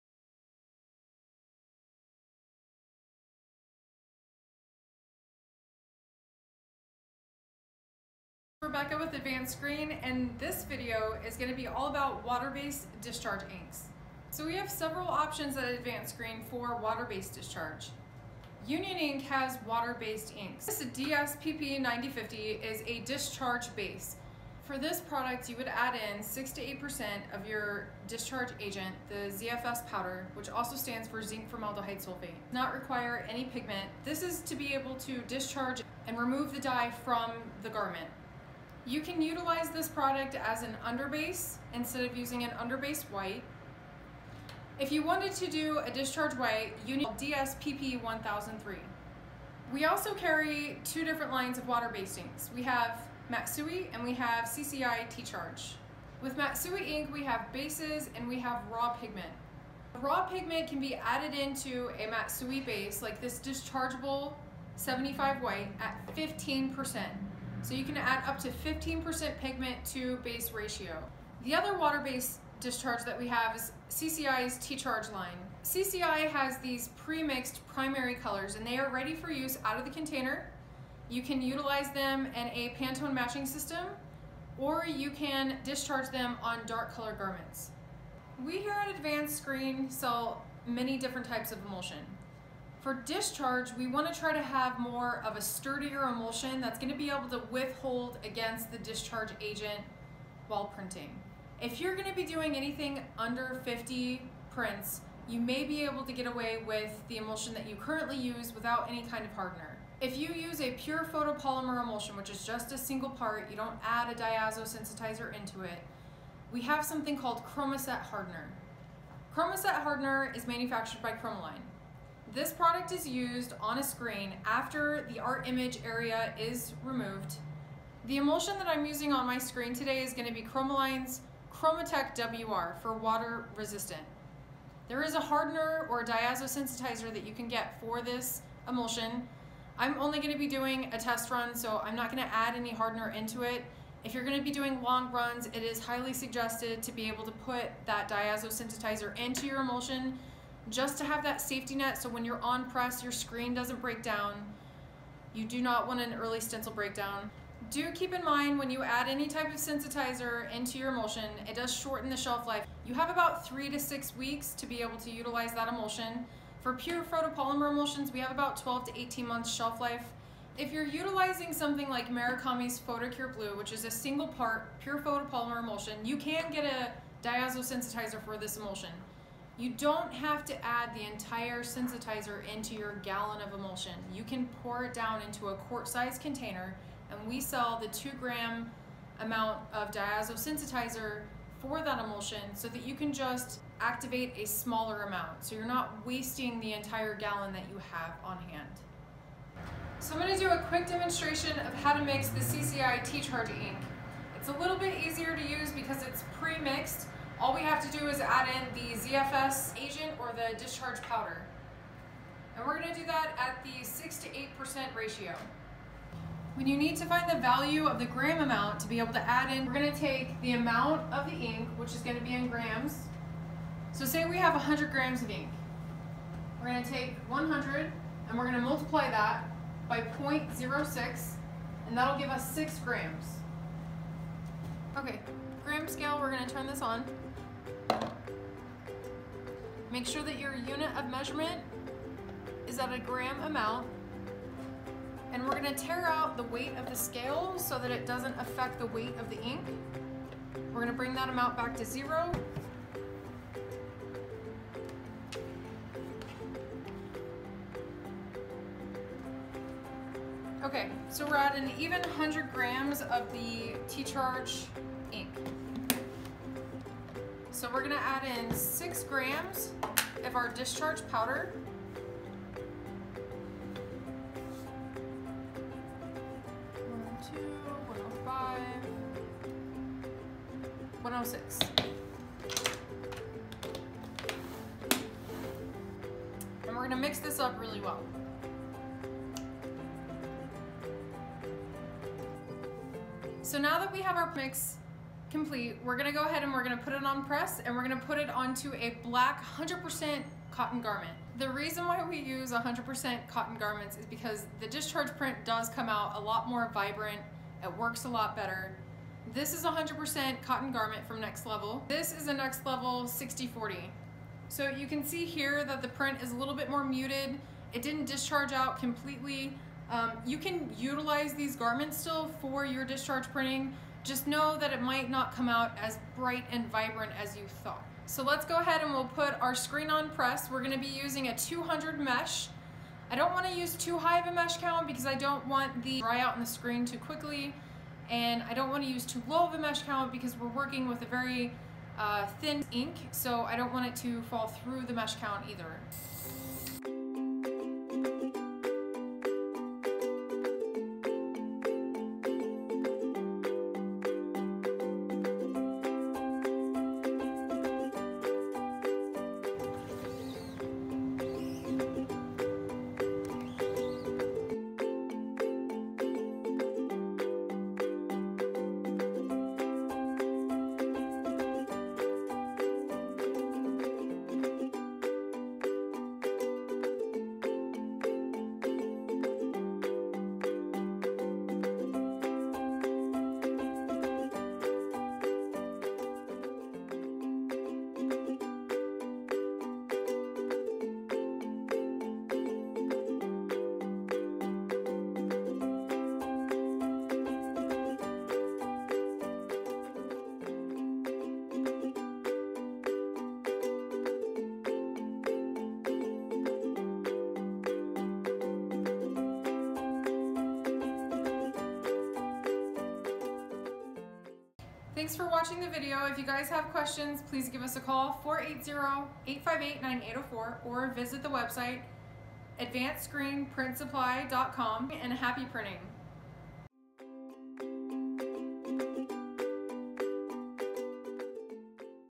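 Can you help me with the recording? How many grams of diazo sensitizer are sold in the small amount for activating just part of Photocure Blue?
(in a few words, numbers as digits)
2 grams.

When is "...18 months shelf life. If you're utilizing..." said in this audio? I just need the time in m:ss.
2:48.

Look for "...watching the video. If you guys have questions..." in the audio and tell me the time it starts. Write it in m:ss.
6:55.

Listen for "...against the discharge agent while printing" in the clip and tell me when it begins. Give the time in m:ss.
1:38.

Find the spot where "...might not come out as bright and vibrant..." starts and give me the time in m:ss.
5:24.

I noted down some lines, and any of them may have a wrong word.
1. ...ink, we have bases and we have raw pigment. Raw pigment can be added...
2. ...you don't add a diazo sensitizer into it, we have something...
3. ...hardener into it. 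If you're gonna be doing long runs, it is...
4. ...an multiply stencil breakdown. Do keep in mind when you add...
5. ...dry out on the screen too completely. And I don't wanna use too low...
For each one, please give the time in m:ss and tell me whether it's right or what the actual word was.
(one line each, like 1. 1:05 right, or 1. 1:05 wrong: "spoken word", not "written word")
1. 0:56 right
2. 1:53 right
3. 2:22 right
4. 2:36 wrong: "early", not "multiply"
5. 5:36 wrong: "quickly", not "completely".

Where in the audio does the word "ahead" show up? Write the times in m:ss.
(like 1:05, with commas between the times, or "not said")
4:56, 5:28.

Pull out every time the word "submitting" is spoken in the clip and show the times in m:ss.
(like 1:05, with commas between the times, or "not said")
not said.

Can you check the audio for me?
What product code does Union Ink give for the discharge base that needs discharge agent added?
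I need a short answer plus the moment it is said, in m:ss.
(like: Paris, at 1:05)
DSPP9050, at 0:20.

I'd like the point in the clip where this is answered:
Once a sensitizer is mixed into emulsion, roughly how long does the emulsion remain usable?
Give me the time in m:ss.
2:43.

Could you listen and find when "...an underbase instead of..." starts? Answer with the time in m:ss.
0:40.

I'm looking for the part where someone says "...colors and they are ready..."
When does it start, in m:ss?
1:18.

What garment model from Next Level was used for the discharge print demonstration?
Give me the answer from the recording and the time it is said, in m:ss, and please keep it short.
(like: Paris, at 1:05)
6040, at 5:13.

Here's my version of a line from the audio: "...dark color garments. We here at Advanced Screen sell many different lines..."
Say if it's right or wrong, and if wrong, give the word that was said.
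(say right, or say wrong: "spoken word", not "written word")
wrong: "types", not "lines".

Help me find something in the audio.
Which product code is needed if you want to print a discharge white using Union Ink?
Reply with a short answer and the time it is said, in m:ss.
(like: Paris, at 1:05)
DSPP 1003, at 0:47.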